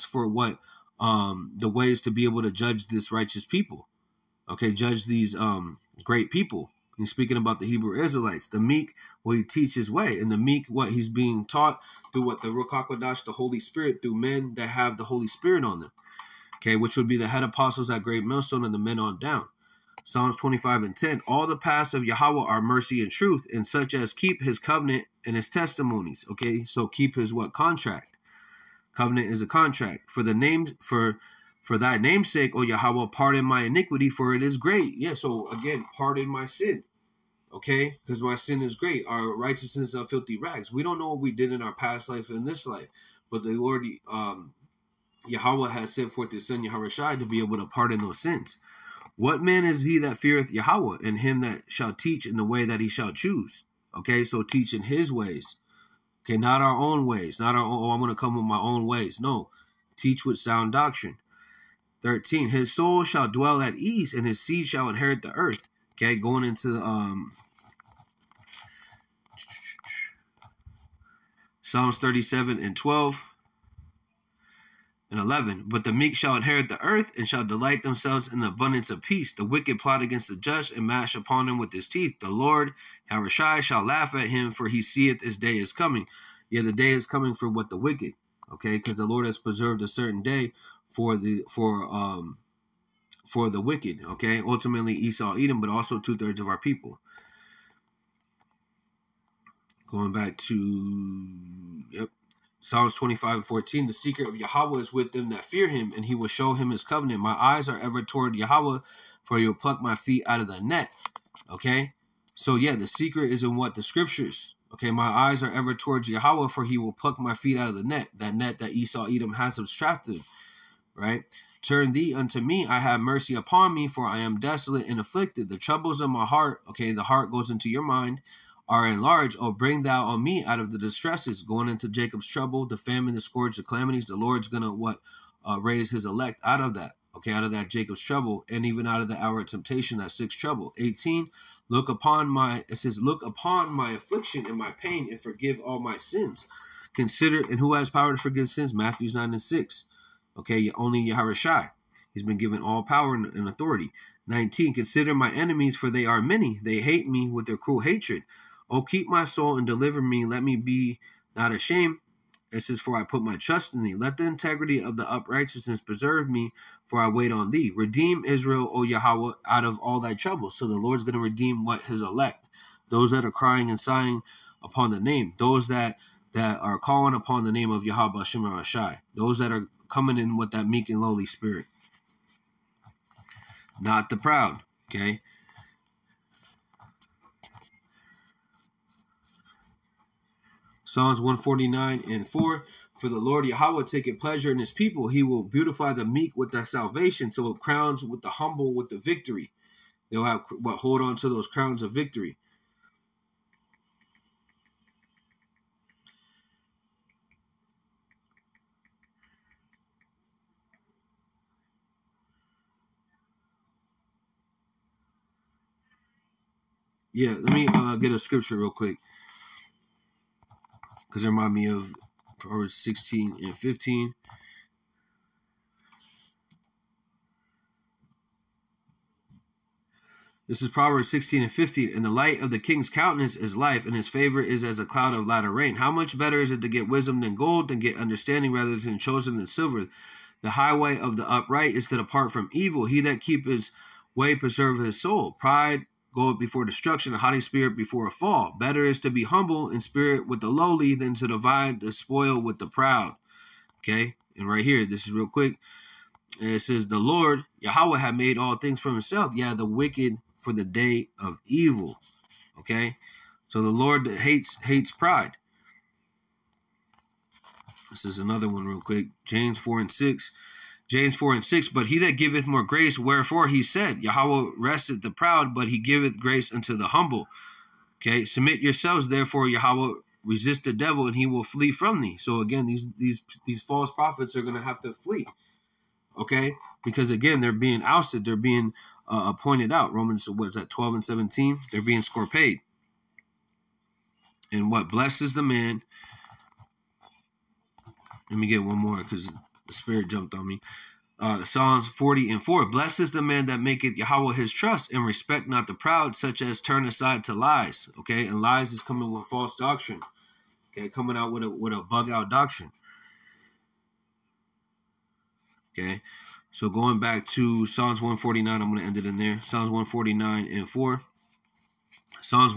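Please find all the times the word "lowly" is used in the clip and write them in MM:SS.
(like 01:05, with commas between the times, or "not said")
03:01, 04:10.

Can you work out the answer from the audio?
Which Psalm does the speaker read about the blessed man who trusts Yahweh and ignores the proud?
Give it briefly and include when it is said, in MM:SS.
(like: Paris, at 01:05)
Psalms 40:4, at 05:01.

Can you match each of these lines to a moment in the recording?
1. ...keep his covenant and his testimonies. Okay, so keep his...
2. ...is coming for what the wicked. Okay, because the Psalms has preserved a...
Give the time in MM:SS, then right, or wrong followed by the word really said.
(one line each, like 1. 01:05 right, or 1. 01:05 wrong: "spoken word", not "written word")
1. 00:24 right
2. 01:26 wrong: "Lord", not "Psalms".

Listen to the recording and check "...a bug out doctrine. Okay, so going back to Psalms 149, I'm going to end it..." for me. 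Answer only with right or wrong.
right.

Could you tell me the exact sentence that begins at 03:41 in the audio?
Because it remind me of Proverbs 16 and 15.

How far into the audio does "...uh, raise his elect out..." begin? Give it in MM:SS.
02:15.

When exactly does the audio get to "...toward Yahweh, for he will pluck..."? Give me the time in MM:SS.
01:48.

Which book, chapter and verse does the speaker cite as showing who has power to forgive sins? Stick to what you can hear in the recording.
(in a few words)
Matthew 9:6.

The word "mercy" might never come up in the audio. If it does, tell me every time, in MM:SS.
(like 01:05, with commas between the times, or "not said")
00:22, 02:02.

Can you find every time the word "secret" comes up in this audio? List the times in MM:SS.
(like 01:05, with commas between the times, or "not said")
01:43, 01:52.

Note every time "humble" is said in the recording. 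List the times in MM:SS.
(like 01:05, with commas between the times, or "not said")
03:18, 04:09, 04:36.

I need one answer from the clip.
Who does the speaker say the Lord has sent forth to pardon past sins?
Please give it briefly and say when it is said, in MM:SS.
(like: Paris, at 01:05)
His Son Yahweh Shai, at 00:46.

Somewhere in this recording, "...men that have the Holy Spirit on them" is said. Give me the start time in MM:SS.
00:14.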